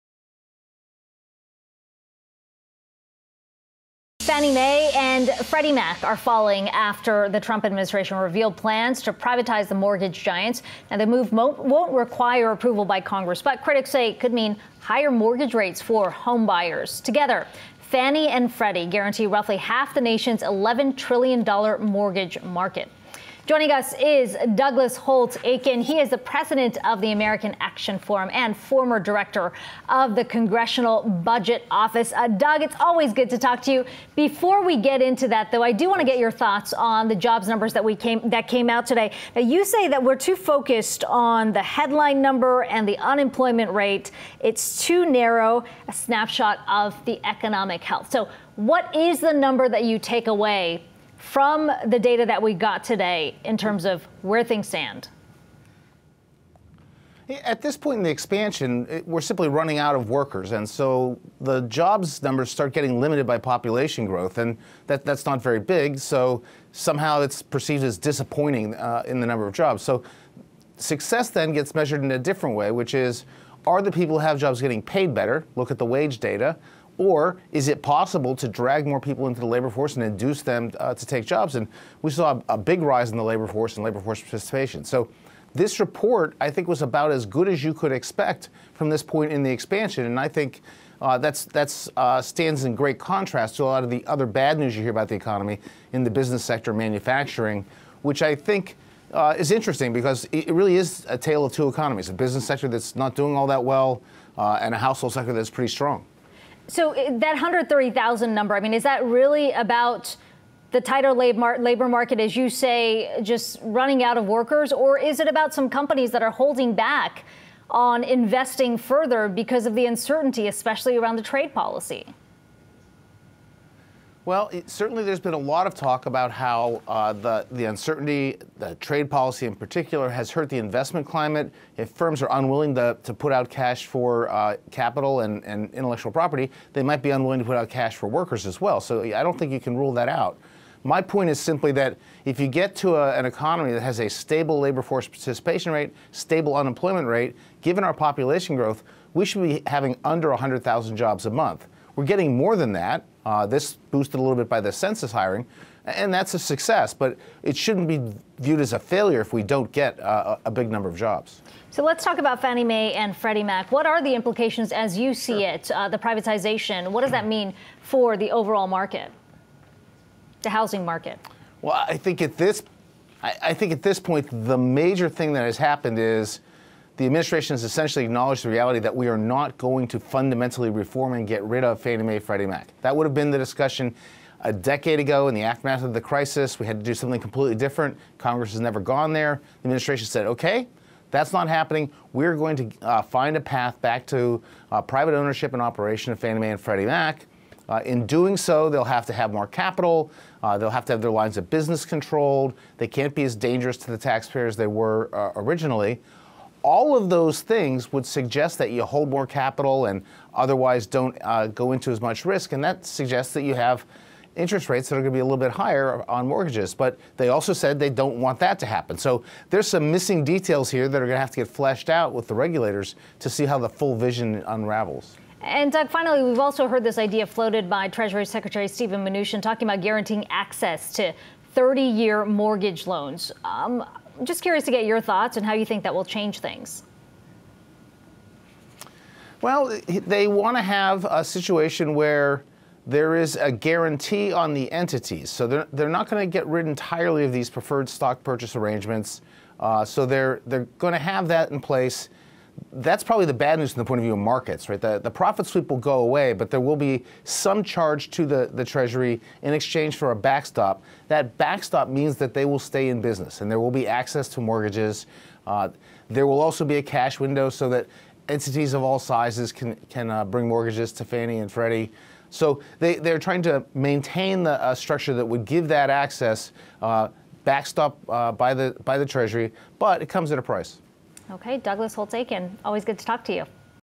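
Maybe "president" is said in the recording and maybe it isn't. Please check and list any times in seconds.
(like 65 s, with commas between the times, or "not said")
26 s.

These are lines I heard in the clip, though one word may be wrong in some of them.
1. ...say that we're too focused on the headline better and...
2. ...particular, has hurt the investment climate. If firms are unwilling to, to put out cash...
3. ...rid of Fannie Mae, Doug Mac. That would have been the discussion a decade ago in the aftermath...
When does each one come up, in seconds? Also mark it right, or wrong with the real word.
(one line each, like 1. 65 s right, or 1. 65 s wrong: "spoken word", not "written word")
1. 39 s wrong: "number", not "better"
2. 129 s right
3. 181 s wrong: "Freddie", not "Doug".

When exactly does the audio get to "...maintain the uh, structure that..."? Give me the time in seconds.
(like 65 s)
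273 s.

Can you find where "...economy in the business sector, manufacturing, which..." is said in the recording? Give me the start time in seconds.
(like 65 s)
95 s.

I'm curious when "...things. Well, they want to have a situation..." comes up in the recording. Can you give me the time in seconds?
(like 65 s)
236 s.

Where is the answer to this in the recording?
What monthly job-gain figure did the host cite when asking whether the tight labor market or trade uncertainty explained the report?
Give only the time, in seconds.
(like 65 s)
107 s.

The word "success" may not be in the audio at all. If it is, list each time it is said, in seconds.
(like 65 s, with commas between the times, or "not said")
70 s, 156 s.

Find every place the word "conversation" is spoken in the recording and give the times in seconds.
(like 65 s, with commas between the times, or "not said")
not said.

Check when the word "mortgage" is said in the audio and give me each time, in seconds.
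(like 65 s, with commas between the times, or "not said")
9 s, 15 s, 21 s, 216 s, 232 s, 264 s, 270 s.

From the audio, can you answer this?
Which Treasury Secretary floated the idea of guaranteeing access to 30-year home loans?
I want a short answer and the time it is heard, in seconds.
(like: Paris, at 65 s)
Stephen Mnuchin, at 228 s.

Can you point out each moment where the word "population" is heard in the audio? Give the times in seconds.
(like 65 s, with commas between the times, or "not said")
63 s, 147 s.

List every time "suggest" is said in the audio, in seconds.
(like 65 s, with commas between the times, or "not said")
208 s, 212 s.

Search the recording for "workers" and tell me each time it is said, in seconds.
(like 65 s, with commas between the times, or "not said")
60 s, 114 s, 138 s.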